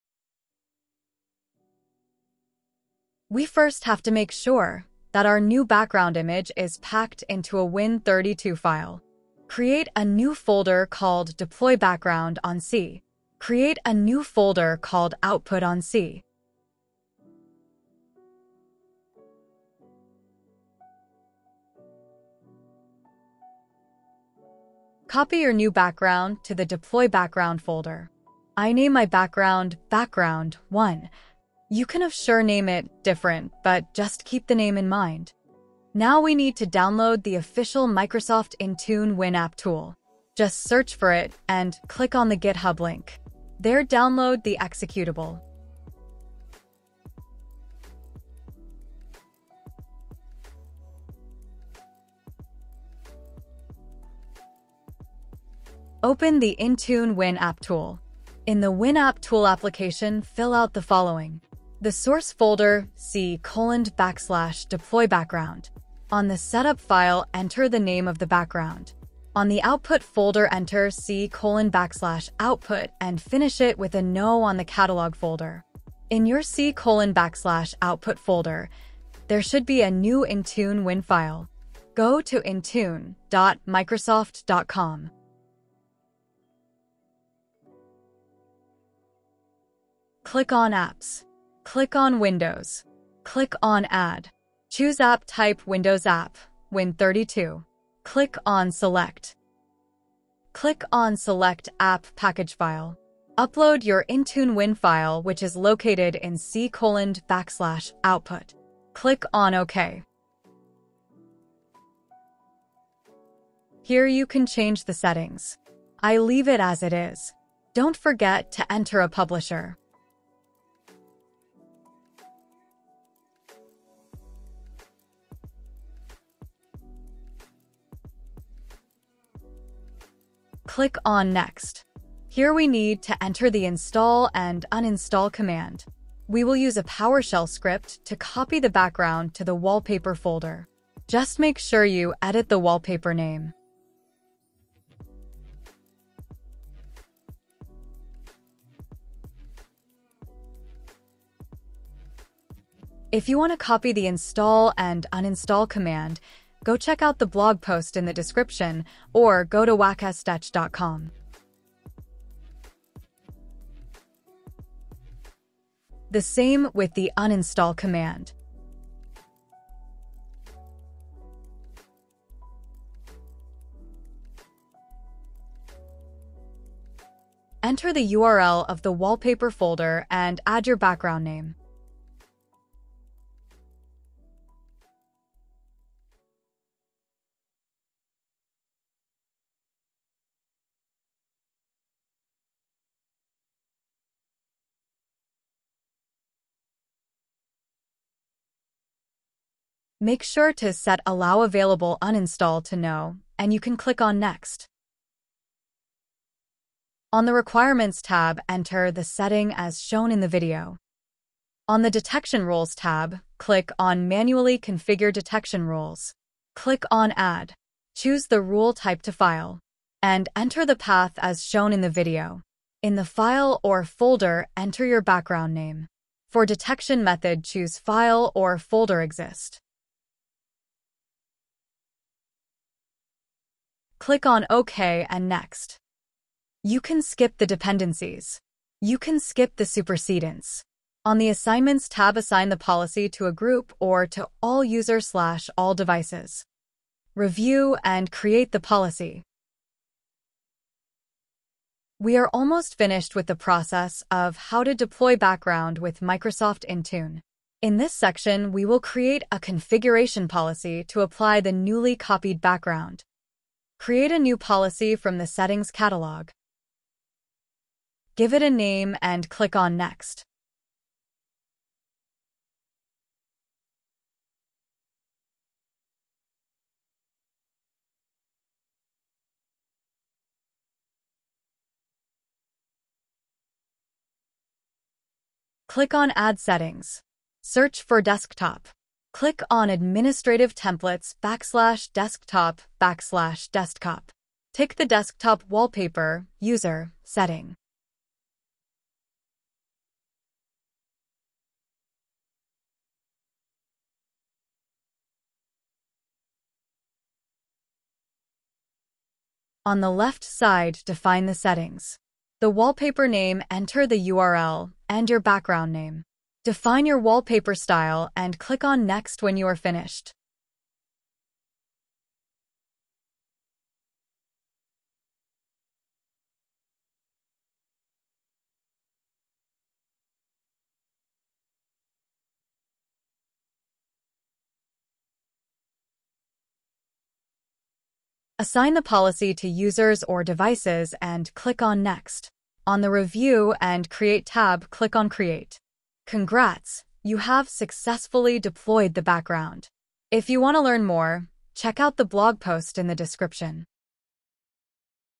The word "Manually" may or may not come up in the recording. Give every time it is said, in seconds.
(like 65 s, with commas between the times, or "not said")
214 s.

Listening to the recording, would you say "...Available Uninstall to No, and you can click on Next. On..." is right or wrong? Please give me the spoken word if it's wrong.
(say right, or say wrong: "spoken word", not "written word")
right.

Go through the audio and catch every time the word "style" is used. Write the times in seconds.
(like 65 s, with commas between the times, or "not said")
317 s.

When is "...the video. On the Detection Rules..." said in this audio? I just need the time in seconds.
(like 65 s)
210 s.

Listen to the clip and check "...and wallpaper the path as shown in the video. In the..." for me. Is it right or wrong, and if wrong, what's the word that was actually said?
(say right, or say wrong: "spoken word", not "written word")
wrong: "enter", not "wallpaper".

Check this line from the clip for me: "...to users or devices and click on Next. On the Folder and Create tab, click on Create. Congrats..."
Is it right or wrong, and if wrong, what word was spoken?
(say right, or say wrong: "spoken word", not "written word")
wrong: "Review", not "Folder".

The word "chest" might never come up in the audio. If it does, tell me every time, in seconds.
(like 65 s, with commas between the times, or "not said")
not said.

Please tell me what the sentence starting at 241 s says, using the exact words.
On the Assignments tab, assign the policy to a group or to all users slash all devices.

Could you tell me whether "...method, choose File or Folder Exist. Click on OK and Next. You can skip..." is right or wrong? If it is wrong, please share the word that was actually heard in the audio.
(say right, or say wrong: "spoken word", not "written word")
right.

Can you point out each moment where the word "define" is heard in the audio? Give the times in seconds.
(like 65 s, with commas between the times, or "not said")
310 s, 316 s.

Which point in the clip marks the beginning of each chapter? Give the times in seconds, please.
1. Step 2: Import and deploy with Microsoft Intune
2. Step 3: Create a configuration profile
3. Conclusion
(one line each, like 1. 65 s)
1. 80 s
2. 258 s
3. 346 s.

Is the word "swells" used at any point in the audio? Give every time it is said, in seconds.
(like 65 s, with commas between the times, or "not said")
not said.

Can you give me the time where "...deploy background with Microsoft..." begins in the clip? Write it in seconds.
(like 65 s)
254 s.